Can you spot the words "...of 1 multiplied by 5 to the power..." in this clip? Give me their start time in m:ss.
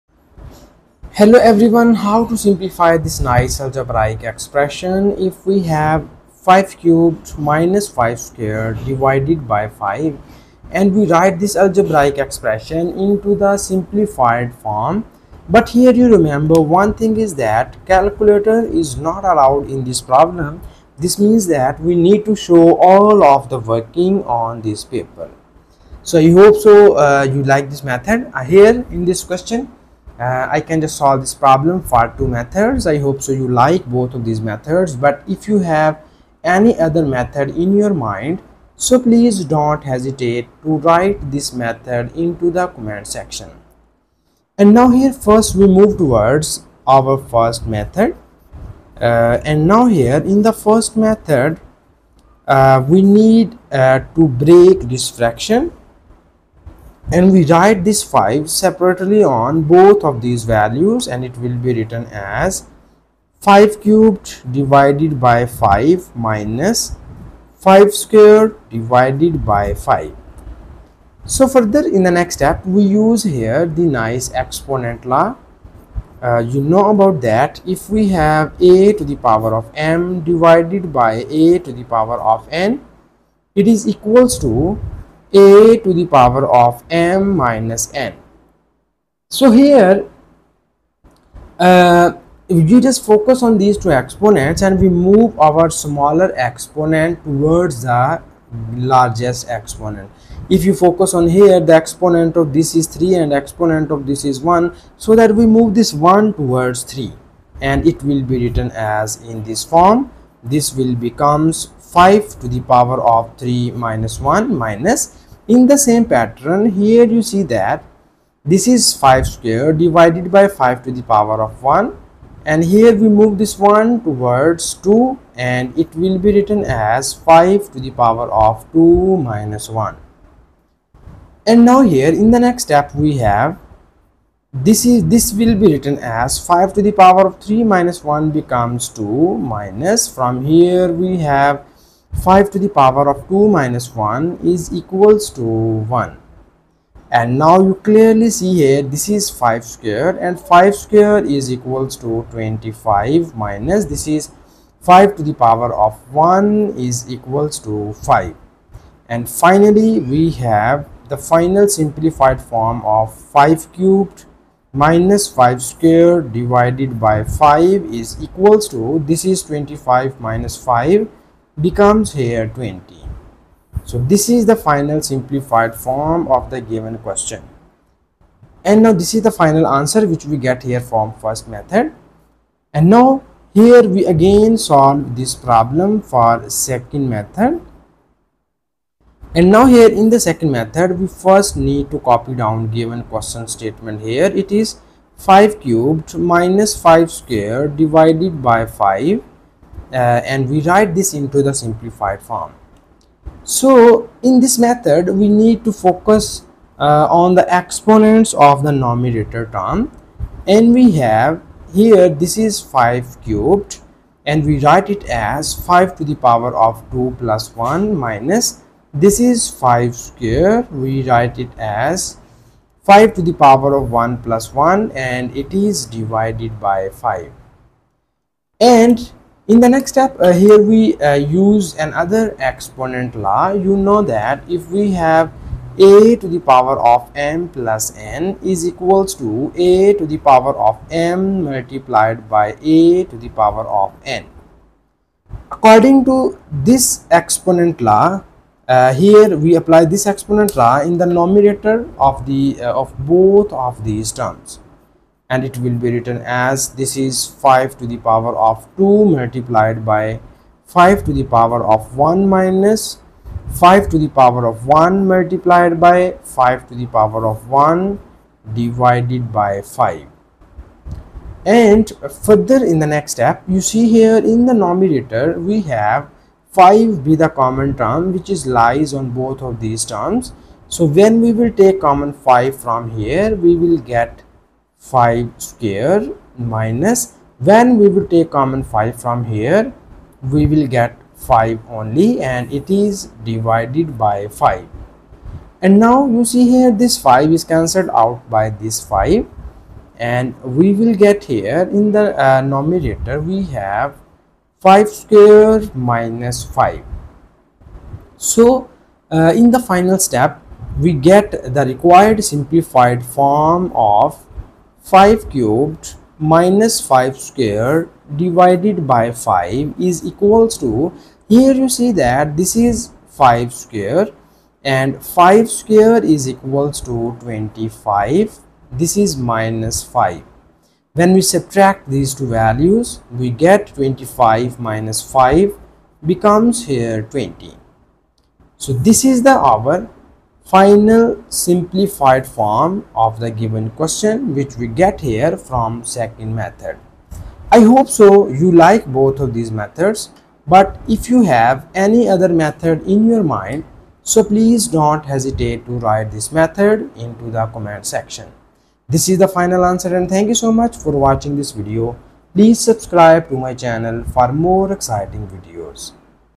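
4:24.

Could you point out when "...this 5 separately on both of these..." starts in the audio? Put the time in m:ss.
0:57.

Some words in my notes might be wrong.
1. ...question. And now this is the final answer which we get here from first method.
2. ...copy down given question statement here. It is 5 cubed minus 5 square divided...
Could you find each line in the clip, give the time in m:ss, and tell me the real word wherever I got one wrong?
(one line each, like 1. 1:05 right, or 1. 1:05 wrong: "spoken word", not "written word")
1. 2:56 right
2. 3:11 right.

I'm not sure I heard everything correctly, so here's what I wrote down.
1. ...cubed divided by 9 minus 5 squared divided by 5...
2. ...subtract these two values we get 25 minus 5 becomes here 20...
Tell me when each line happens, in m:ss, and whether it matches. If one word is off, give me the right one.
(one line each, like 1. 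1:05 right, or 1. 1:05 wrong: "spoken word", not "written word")
1. 1:03 wrong: "5", not "9"
2. 5:31 right.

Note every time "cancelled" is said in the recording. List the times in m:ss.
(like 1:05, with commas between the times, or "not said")
4:57.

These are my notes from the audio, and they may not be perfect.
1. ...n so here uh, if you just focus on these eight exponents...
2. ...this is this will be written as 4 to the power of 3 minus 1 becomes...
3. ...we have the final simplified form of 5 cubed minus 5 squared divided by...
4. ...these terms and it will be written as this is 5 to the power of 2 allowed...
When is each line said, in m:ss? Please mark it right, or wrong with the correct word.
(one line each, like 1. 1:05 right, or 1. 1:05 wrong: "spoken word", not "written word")
1. 1:27 wrong: "two", not "eight"
2. 2:14 wrong: "5", not "4"
3. 2:39 right
4. 4:13 wrong: "multiplied", not "allowed".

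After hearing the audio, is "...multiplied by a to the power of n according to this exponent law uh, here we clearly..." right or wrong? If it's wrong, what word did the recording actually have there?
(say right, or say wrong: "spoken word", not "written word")
wrong: "apply", not "clearly".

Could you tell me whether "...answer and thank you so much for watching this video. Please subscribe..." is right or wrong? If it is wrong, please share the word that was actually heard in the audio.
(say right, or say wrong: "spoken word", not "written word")
right.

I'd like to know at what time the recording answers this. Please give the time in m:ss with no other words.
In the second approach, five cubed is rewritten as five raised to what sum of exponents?
3:36.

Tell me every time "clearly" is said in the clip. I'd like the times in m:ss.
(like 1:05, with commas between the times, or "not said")
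2:27.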